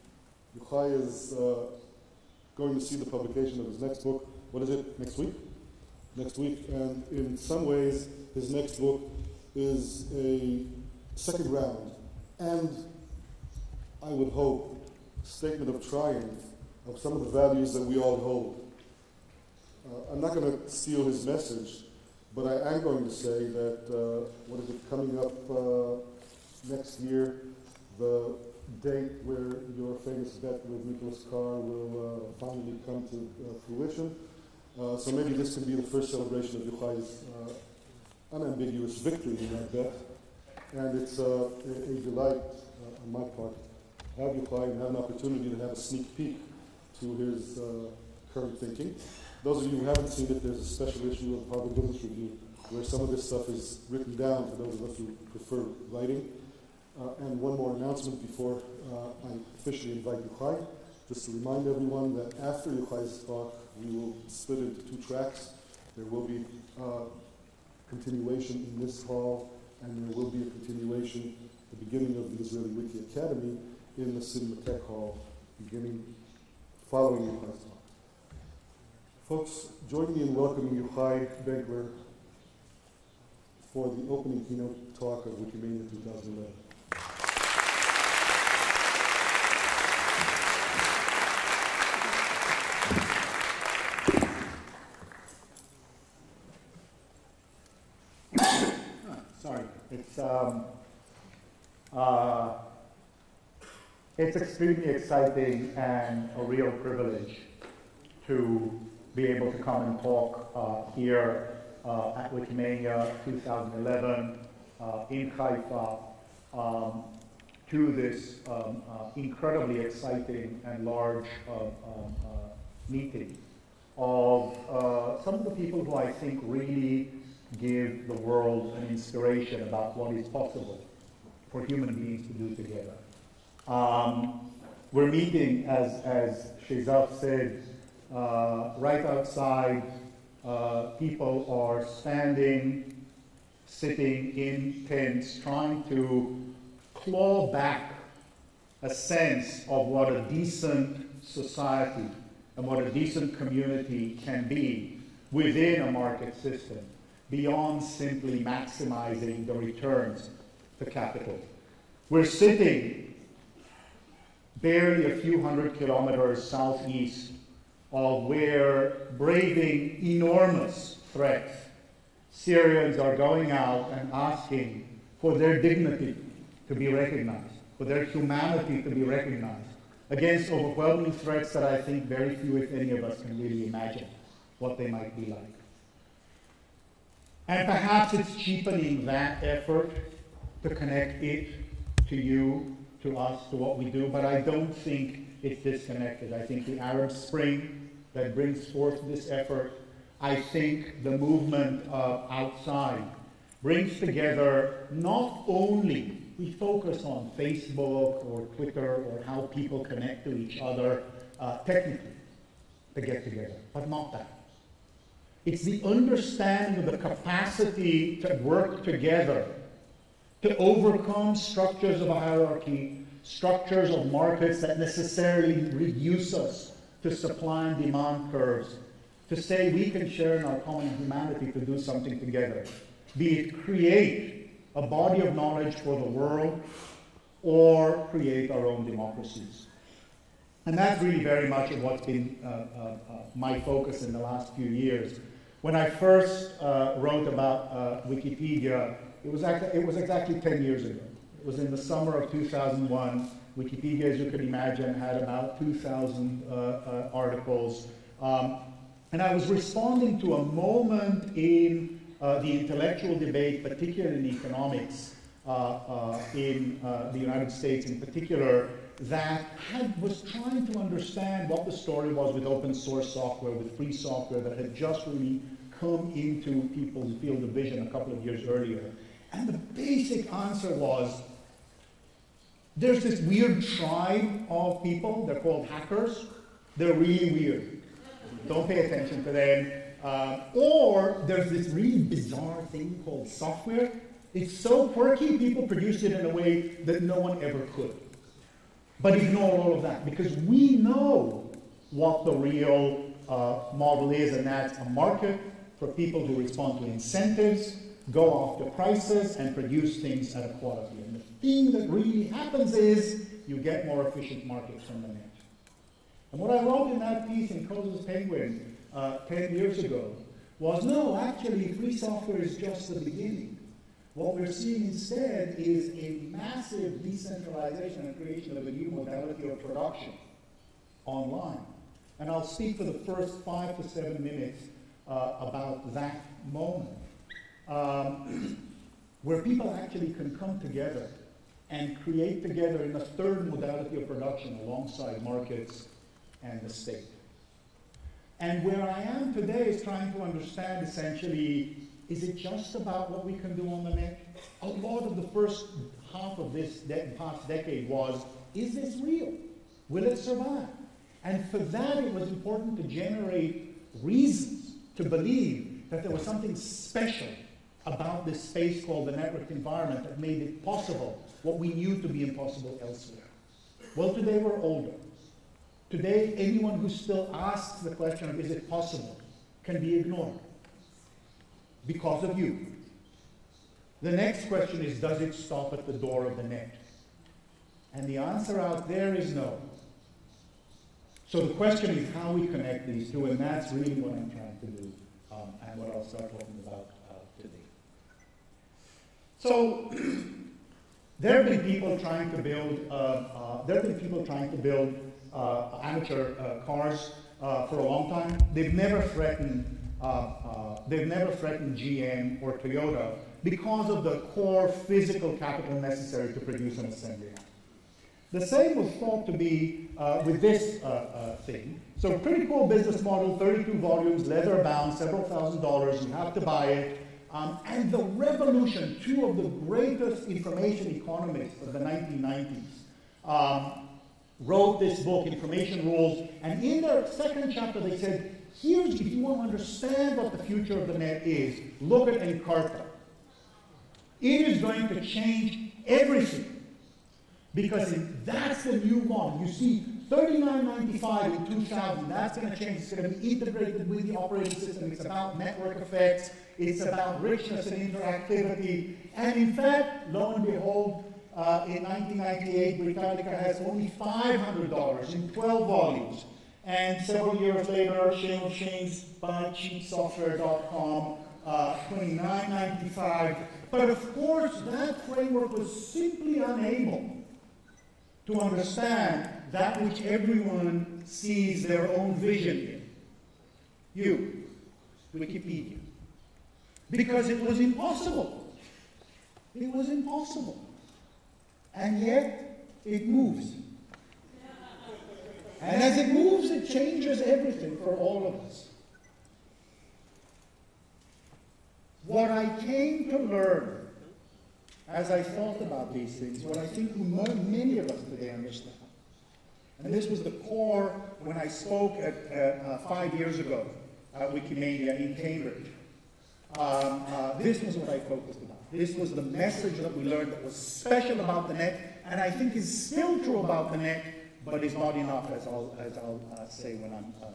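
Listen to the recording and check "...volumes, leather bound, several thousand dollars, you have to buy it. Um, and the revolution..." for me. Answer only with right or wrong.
right.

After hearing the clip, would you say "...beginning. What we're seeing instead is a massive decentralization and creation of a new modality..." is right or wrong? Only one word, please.
right.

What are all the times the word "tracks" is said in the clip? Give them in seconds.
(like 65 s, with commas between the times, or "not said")
65 s.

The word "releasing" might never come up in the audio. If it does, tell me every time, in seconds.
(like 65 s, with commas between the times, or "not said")
not said.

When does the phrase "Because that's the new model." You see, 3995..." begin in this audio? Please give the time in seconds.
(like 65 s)
447 s.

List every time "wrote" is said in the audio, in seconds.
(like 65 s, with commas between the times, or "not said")
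246 s, 316 s, 434 s.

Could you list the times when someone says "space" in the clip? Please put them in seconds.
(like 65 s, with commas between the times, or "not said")
368 s.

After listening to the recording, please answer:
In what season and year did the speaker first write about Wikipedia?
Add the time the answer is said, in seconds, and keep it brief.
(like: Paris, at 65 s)
summer of 2001, at 251 s.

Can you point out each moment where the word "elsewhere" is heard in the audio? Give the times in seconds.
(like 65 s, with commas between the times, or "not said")
372 s.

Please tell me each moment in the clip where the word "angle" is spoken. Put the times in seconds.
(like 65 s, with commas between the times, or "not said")
not said.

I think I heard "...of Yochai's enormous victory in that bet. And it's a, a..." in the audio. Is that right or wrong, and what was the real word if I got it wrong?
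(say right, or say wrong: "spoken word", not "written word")
wrong: "unambiguous", not "enormous".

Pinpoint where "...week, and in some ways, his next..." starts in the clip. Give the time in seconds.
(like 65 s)
6 s.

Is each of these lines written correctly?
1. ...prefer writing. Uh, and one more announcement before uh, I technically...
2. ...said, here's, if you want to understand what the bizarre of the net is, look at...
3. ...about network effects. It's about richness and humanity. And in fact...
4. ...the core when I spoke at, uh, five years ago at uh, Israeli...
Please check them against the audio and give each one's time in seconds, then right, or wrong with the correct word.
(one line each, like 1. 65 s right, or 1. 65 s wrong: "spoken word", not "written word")
1. 55 s wrong: "officially", not "technically"
2. 437 s wrong: "future", not "bizarre"
3. 455 s wrong: "interactivity", not "humanity"
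4. 510 s wrong: "Wikimania", not "Israeli".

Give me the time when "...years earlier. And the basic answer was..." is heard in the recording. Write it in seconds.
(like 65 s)
278 s.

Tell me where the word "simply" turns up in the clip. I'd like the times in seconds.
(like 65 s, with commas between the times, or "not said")
157 s, 475 s.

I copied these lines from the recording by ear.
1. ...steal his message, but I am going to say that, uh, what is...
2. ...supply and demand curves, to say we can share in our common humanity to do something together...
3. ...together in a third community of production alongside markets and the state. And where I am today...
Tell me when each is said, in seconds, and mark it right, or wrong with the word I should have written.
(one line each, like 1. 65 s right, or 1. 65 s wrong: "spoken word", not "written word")
1. 20 s right
2. 227 s right
3. 342 s wrong: "modality", not "community".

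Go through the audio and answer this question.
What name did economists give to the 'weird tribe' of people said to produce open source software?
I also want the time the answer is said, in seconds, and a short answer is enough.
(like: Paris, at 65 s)
hackers, at 285 s.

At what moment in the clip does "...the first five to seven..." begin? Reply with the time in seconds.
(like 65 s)
332 s.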